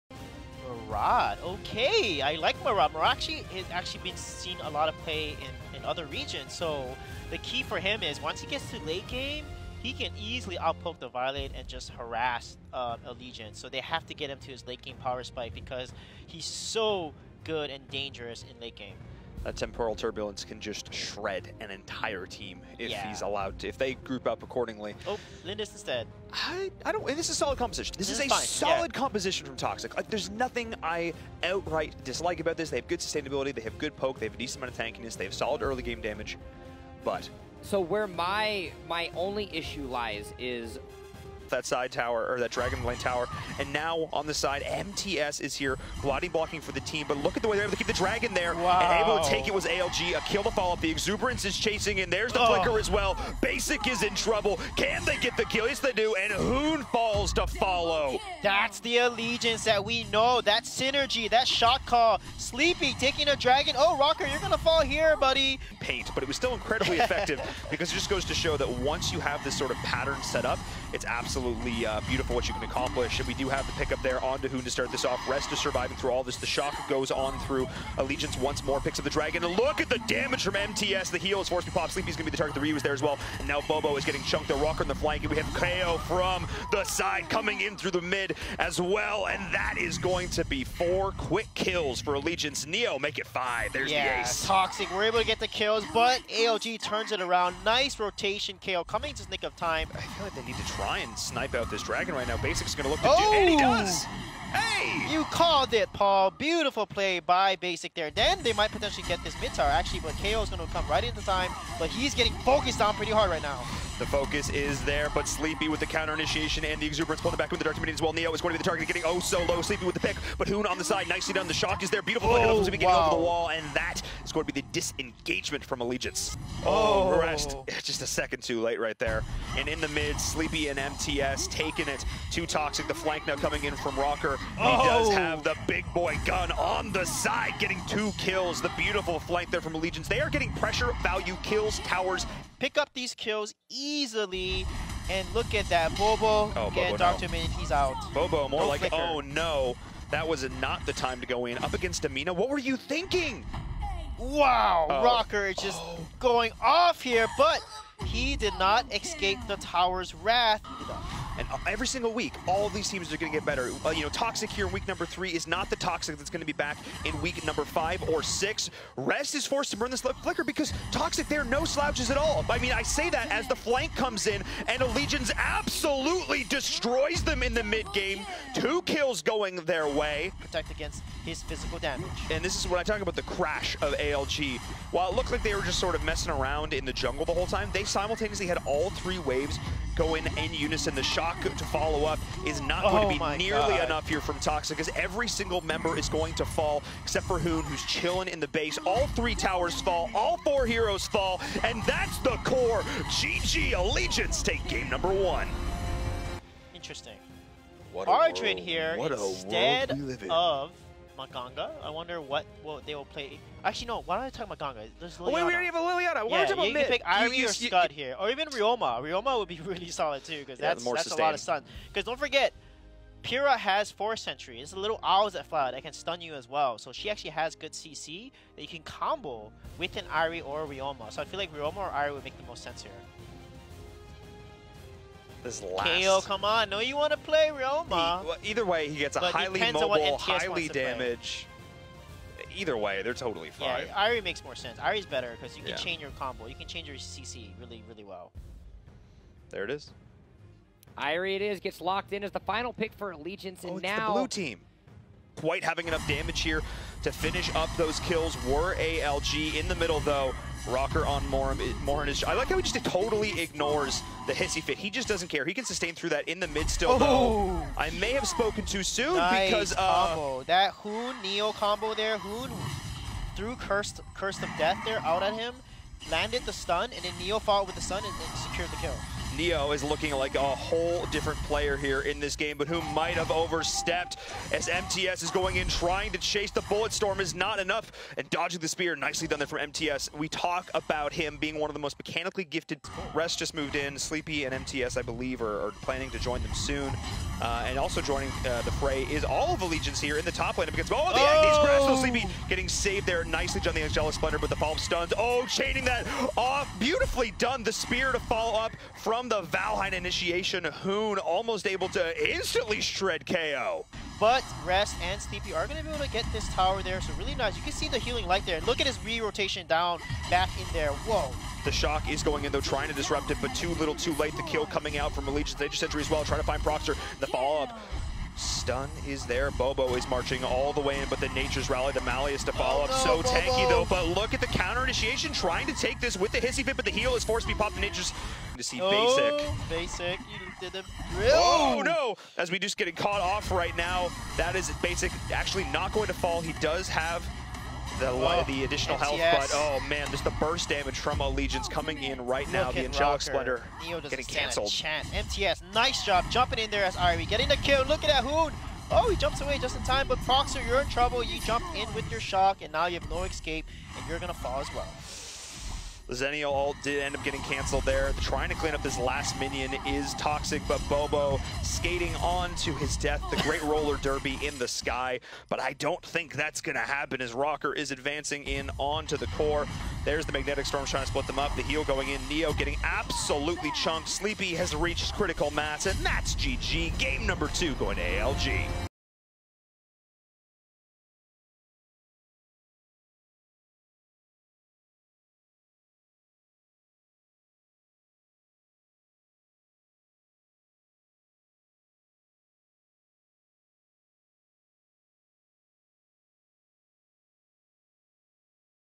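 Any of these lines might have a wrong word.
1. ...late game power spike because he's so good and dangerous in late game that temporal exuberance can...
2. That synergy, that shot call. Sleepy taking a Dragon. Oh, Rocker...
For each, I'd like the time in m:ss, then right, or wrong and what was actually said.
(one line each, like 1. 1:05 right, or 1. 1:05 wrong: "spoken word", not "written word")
1. 0:14 wrong: "turbulence", not "exuberance"
2. 1:00 right.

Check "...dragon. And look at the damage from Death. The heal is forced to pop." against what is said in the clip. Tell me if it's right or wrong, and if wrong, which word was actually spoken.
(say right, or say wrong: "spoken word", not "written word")
wrong: "MTS", not "Death".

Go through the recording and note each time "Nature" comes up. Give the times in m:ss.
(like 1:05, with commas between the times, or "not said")
5:31, 5:37.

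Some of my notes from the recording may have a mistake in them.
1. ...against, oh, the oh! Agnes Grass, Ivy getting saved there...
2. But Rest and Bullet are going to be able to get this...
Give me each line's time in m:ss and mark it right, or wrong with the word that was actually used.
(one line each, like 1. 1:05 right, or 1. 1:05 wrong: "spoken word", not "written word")
1. 5:00 wrong: "Sleepy", not "Ivy"
2. 5:14 wrong: "Sleepy", not "Bullet".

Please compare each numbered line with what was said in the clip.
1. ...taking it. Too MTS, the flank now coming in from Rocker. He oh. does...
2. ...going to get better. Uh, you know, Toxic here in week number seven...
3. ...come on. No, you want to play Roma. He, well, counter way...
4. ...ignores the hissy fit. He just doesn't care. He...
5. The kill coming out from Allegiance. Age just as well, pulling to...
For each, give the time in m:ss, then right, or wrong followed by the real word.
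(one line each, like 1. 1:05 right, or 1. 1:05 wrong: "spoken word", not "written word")
1. 2:11 wrong: "Toxic", not "MTS"
2. 2:43 wrong: "three", not "seven"
3. 3:56 wrong: "either", not "counter"
4. 4:23 right
5. 5:24 wrong: "trying", not "pulling".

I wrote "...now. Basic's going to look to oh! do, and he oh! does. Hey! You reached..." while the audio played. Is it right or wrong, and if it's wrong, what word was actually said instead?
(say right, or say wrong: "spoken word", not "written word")
wrong: "called", not "reached".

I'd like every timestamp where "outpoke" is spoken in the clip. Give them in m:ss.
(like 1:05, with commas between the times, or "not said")
0:10.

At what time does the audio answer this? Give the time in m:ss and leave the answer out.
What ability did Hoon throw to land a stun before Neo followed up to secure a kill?
4:34.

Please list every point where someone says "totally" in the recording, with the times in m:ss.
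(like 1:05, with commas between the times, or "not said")
4:03, 4:22.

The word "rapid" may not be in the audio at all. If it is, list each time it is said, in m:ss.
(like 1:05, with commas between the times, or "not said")
not said.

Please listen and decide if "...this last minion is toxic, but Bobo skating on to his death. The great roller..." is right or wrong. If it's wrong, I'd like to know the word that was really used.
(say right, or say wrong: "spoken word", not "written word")
right.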